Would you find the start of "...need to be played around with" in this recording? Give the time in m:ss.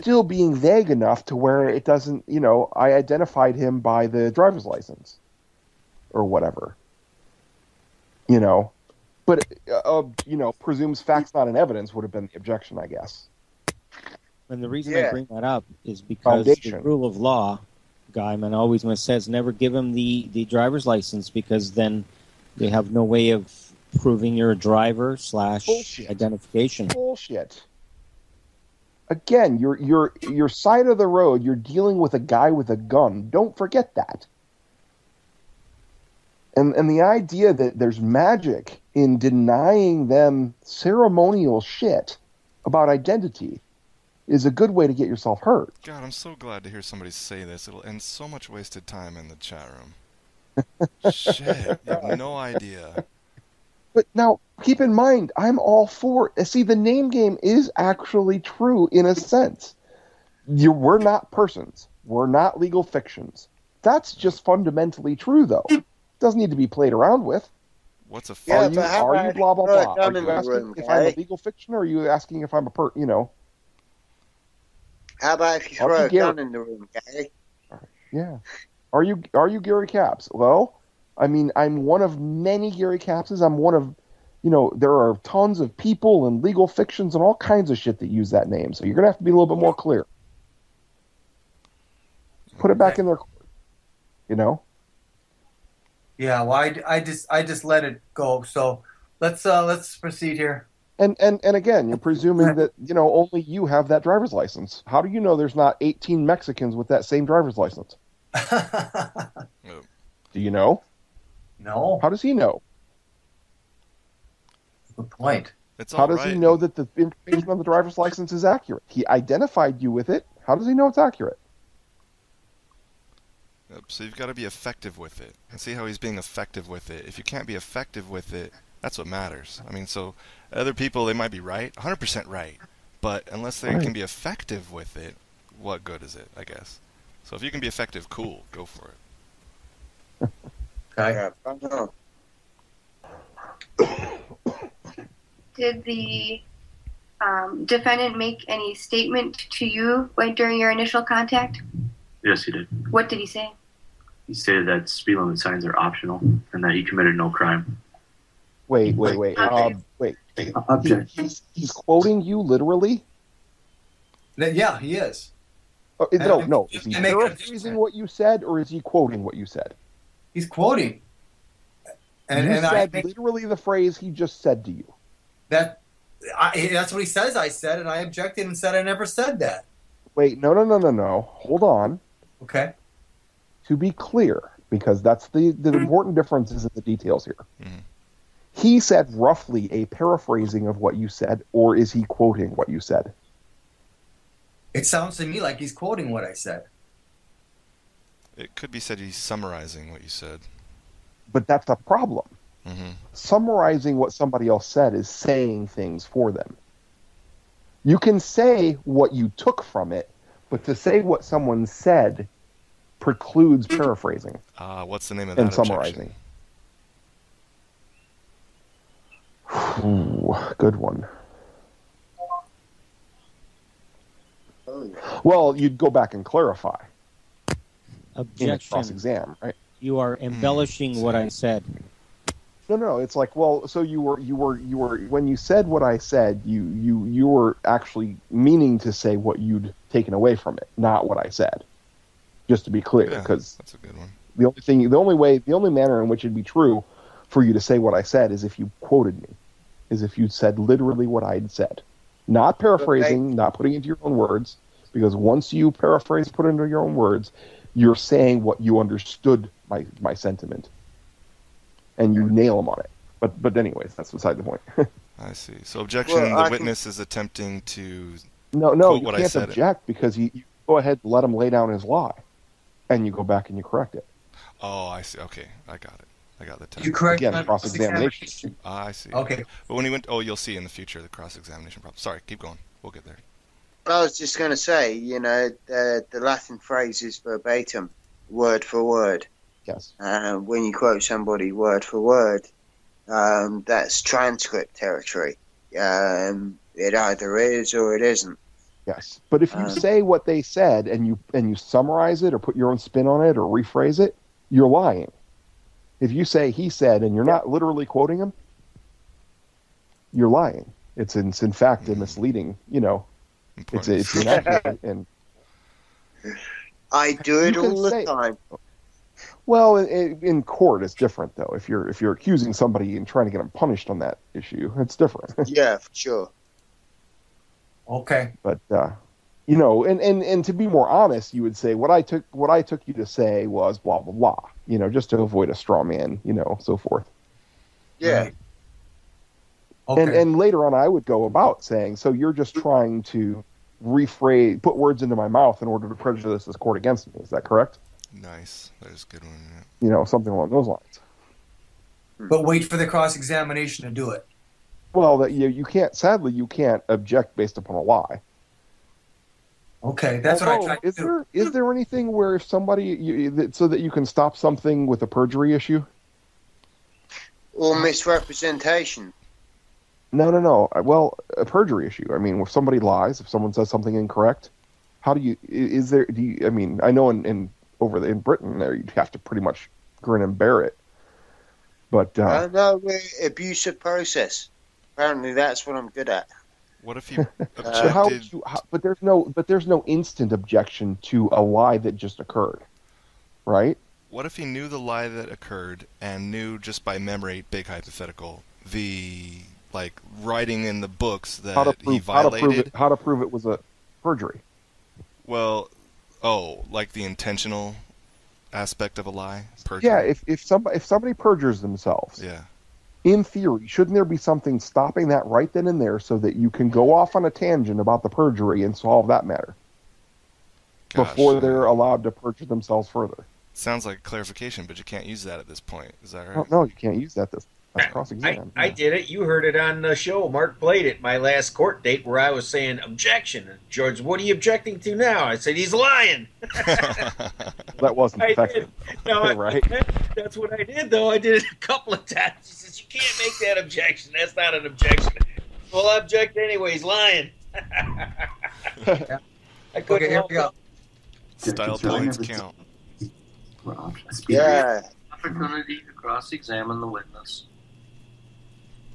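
1:06.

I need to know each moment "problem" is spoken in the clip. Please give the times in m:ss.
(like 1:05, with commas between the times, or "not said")
3:21, 4:41.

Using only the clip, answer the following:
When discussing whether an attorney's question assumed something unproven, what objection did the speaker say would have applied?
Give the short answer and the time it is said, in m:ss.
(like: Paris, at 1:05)
Presumes facts not in evidence, at 0:10.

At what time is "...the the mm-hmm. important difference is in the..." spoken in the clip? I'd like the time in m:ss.
3:05.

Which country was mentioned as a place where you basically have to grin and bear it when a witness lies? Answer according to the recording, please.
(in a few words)
Britain.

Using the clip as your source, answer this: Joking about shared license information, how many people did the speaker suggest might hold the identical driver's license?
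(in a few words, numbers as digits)
18.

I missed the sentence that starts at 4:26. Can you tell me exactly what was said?
is attempting to no no you can't object it.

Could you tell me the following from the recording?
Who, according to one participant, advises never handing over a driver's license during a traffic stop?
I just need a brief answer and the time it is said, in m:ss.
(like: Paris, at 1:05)
Guyman, at 0:18.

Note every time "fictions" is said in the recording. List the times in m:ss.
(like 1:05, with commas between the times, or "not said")
1:02, 1:11, 1:26.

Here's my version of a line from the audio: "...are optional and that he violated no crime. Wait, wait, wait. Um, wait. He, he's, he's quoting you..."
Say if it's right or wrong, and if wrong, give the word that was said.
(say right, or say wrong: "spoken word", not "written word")
wrong: "committed", not "violated".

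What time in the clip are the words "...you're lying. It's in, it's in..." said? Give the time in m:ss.
5:10.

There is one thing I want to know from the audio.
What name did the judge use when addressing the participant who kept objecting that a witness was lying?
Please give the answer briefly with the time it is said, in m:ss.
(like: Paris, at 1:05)
George, at 7:13.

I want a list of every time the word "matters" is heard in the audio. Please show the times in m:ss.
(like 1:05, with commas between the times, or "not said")
2:09, 6:59.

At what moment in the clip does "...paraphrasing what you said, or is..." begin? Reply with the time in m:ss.
2:46.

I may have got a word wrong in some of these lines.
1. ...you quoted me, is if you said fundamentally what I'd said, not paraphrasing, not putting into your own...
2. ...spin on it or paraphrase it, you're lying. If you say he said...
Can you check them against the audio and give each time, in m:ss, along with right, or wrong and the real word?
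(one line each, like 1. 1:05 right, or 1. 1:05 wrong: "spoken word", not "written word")
1. 4:08 wrong: "literally", not "fundamentally"
2. 5:02 wrong: "rephrase", not "paraphrase".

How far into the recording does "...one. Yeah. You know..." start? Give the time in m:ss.
5:49.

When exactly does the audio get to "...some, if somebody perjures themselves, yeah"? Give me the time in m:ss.
6:50.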